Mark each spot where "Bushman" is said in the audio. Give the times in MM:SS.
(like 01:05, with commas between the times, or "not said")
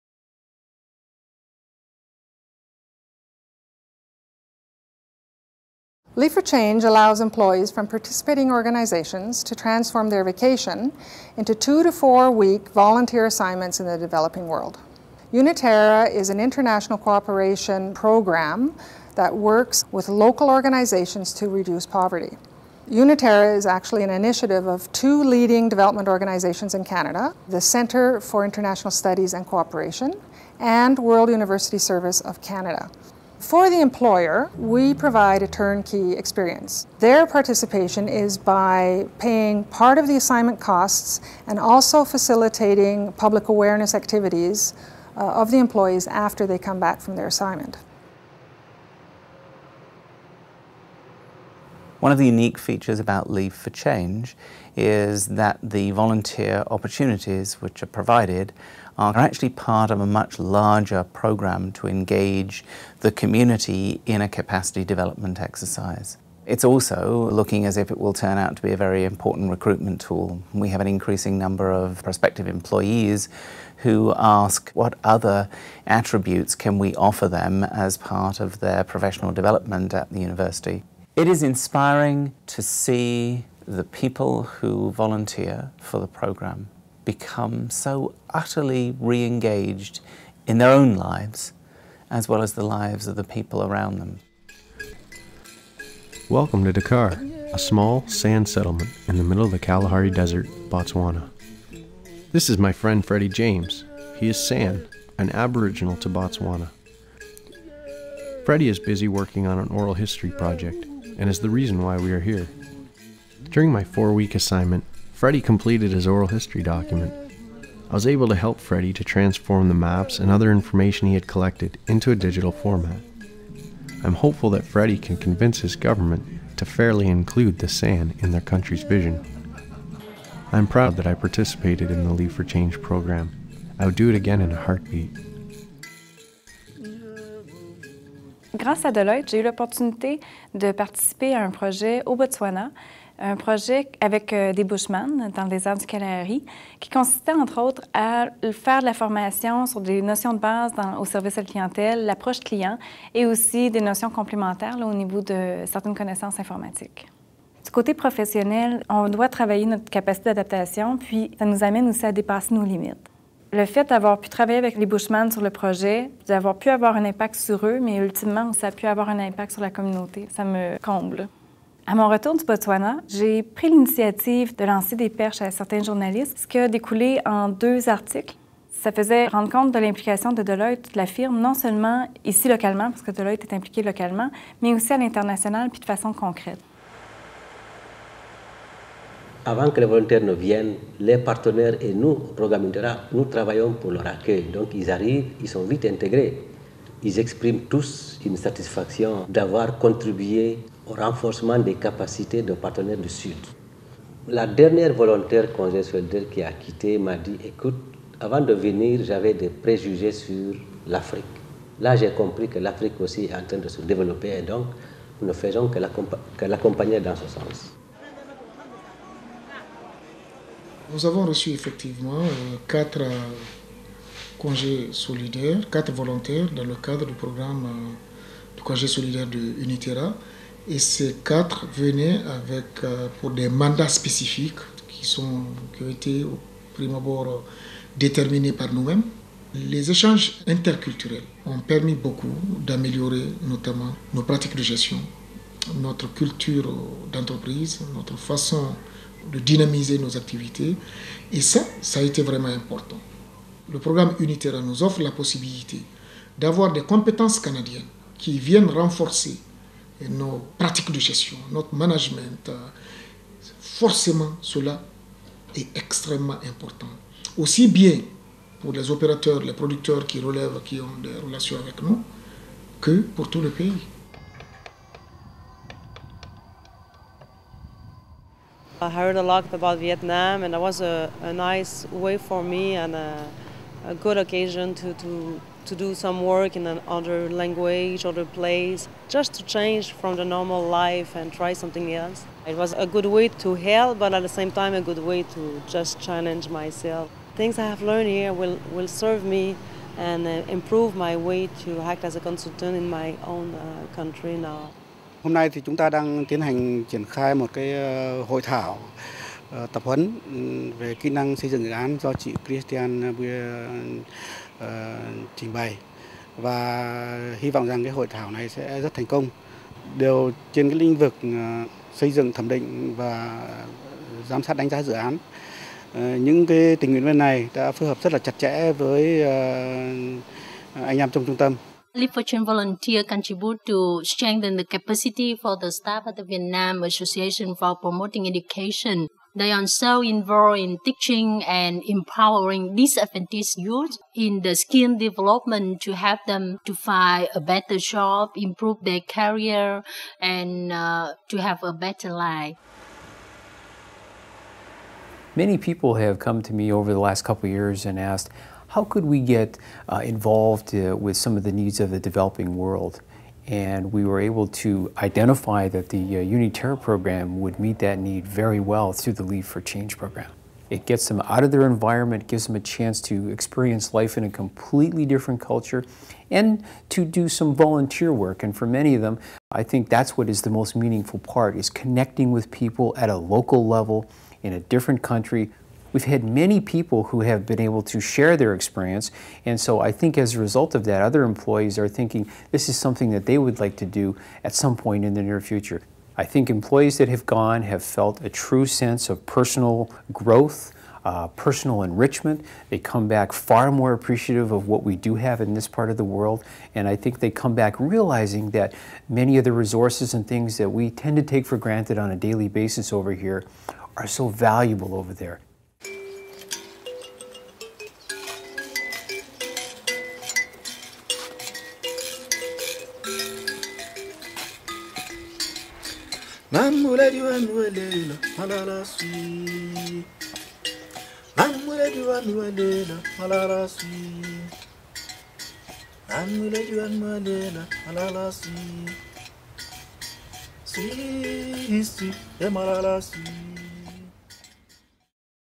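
02:24, 02:44.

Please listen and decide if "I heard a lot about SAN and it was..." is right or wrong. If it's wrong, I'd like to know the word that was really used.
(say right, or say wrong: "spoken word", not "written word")
wrong: "Vietnam", not "SAN".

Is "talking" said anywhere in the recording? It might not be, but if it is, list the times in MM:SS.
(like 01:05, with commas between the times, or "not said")
not said.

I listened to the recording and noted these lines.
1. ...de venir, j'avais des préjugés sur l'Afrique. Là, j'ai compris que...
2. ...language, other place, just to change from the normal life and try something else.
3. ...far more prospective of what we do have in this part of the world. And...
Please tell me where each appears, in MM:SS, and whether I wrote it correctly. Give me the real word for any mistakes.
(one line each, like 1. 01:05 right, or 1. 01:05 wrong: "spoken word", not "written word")
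1. 03:28 right
2. 04:47 right
3. 06:43 wrong: "appreciative", not "prospective".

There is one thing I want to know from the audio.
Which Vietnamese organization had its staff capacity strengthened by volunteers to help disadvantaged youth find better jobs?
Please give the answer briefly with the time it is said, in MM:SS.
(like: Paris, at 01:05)
Vietnam Association for Promoting Education, at 05:36.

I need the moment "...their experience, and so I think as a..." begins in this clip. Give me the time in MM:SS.
06:28.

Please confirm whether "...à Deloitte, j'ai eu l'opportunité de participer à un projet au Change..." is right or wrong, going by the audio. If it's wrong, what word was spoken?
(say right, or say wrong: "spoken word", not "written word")
wrong: "Botswana", not "Change".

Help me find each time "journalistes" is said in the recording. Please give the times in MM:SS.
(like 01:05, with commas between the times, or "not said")
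02:55.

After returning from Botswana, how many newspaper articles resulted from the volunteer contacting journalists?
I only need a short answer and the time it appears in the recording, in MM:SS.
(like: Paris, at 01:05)
2, at 02:57.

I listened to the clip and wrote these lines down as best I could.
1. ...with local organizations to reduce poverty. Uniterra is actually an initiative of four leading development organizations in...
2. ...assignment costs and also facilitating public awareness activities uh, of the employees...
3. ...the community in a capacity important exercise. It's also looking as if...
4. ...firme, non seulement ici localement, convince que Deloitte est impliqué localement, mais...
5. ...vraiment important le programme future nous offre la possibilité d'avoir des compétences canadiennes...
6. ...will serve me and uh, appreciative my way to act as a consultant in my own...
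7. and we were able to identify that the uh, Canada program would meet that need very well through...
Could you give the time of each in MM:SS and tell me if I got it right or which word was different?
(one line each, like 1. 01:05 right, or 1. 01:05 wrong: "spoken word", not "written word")
1. 00:19 wrong: "two", not "four"
2. 00:40 right
3. 01:02 wrong: "development", not "important"
4. 03:01 wrong: "parce", not "convince"
5. 04:12 wrong: "unitaire", not "future"
6. 04:58 wrong: "improve", not "appreciative"
7. 06:03 wrong: "UNITERRA", not "Canada".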